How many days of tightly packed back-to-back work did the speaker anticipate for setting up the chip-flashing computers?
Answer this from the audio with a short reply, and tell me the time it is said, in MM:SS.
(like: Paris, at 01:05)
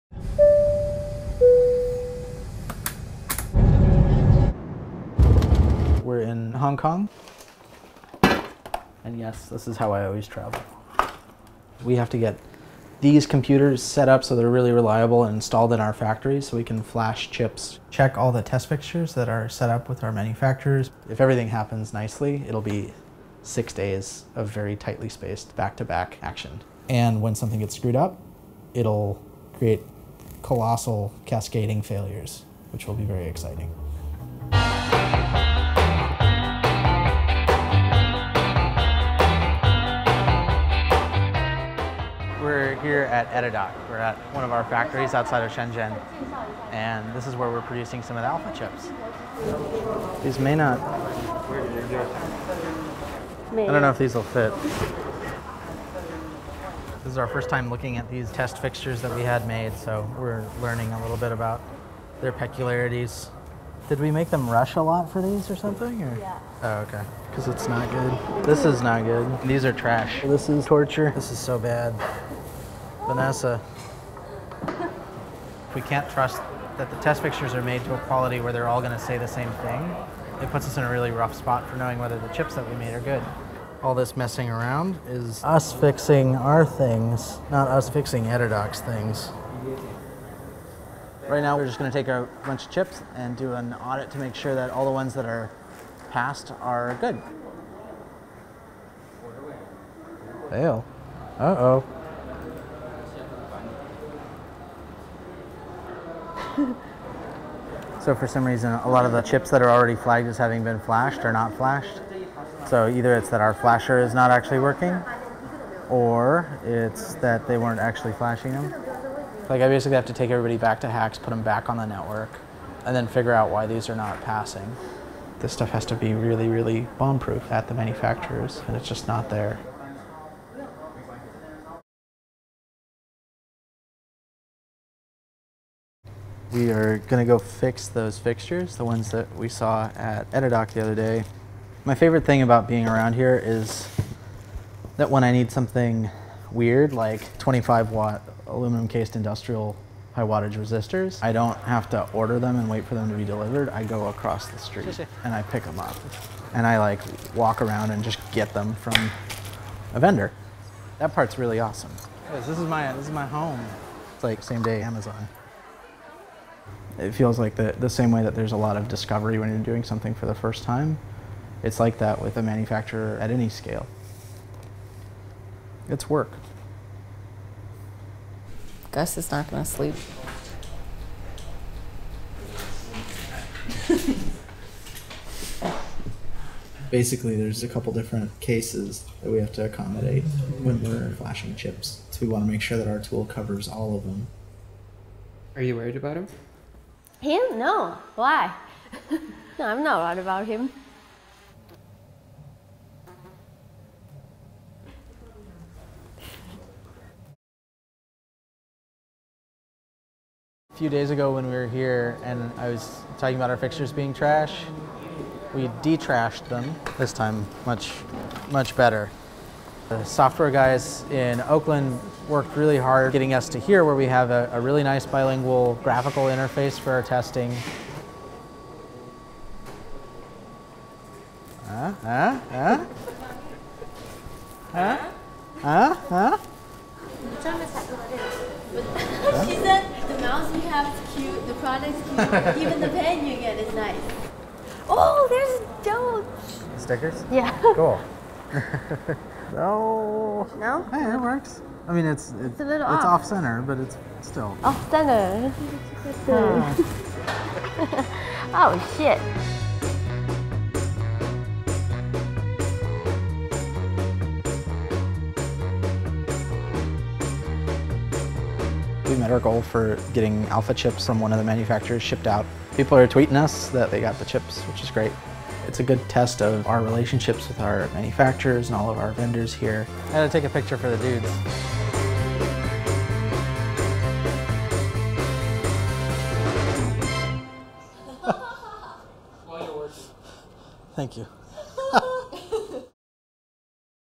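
6 days, at 00:23.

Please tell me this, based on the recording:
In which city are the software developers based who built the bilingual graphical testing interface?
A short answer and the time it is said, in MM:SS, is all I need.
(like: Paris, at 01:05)
Oakland, at 03:41.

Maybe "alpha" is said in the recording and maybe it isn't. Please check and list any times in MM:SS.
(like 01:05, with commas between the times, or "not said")
00:48, 04:30.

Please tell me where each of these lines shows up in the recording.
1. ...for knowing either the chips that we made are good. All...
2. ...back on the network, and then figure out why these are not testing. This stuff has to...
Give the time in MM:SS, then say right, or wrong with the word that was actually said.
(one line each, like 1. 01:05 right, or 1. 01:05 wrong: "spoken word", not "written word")
1. 01:21 wrong: "whether", not "either"
2. 02:01 wrong: "passing", not "testing".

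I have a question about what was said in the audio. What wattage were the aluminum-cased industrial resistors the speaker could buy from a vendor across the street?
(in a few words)
25 watt.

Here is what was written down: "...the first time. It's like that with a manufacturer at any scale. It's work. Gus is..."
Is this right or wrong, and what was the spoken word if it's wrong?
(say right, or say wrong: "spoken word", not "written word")
right.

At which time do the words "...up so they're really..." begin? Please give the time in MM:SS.
00:14.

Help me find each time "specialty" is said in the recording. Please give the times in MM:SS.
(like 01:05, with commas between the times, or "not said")
not said.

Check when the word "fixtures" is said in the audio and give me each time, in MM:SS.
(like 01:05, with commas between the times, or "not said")
00:18, 00:58, 01:17, 02:18, 03:33.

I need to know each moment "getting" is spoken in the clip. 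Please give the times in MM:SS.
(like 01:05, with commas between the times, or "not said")
03:43, 04:30.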